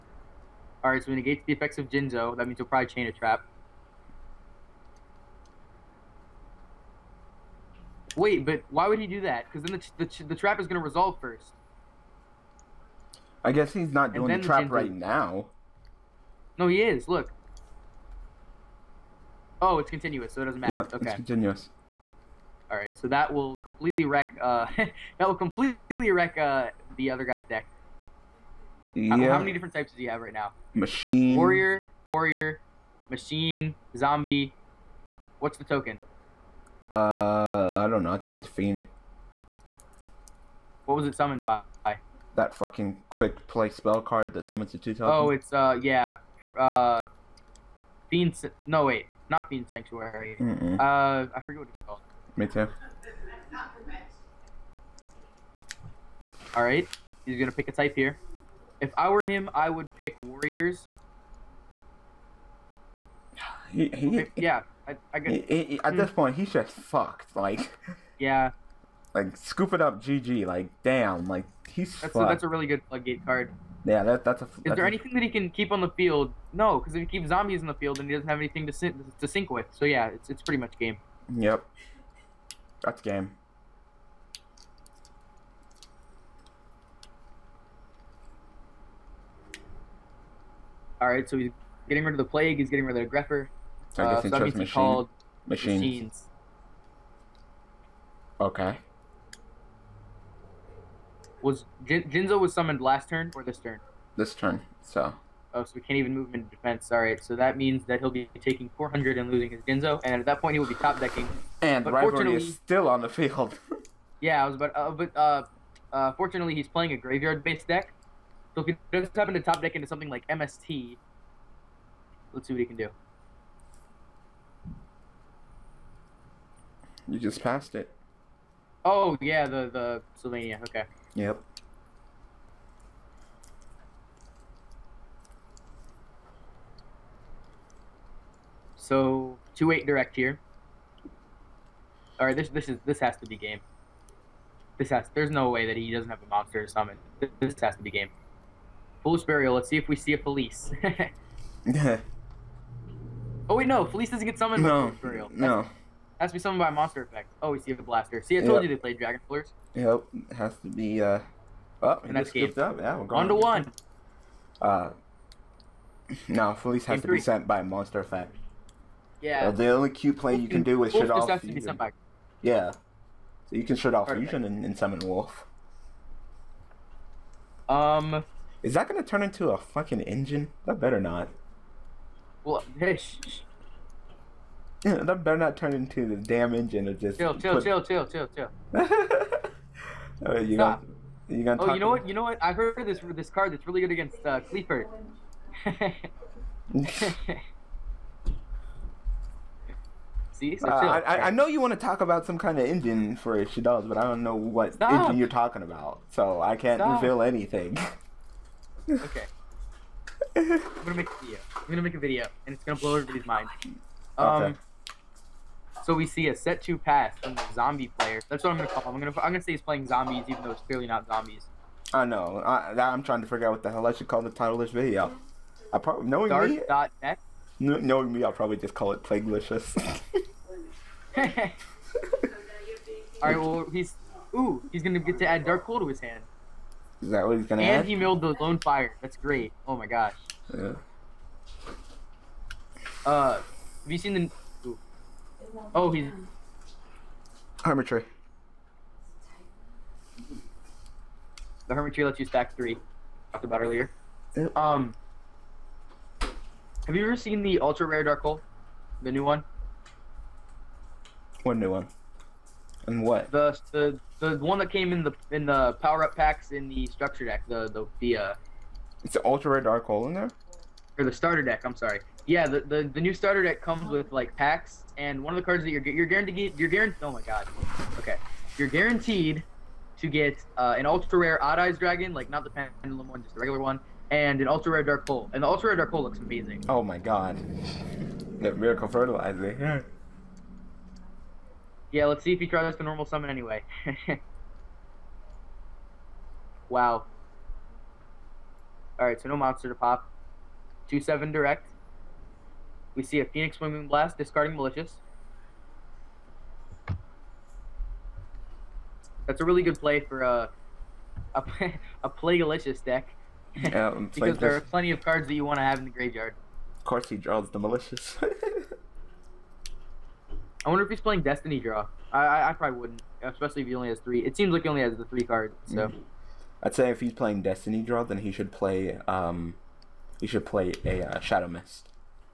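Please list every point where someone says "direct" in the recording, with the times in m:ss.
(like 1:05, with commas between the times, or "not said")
2:19, 5:01.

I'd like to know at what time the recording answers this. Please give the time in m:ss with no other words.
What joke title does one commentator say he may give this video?
3:49.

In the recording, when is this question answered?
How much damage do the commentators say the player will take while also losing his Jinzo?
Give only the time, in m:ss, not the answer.
1:48.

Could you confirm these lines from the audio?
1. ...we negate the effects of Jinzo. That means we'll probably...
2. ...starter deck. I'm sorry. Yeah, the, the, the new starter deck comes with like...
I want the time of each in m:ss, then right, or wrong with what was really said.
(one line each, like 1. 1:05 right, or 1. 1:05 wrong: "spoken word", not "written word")
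1. 0:01 right
2. 4:31 right.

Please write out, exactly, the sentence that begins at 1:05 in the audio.
He, at this point, he's just fucked.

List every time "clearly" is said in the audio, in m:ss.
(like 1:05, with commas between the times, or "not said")
3:40.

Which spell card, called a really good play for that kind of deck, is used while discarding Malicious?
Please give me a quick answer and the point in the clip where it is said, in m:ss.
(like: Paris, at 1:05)
Phoenix Wing Wind Blast, at 5:03.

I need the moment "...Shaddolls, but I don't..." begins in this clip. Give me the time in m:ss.
3:23.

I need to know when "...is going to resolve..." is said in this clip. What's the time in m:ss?
0:10.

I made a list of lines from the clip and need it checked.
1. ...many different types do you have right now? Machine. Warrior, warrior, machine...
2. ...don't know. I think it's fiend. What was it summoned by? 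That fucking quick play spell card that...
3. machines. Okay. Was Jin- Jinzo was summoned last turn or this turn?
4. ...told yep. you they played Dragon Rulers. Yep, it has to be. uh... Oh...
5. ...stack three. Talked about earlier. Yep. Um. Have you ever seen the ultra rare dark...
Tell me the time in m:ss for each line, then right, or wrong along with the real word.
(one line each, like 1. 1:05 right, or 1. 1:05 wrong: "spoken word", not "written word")
1. 0:29 right
2. 0:37 right
3. 1:35 right
4. 2:38 right
5. 4:12 right.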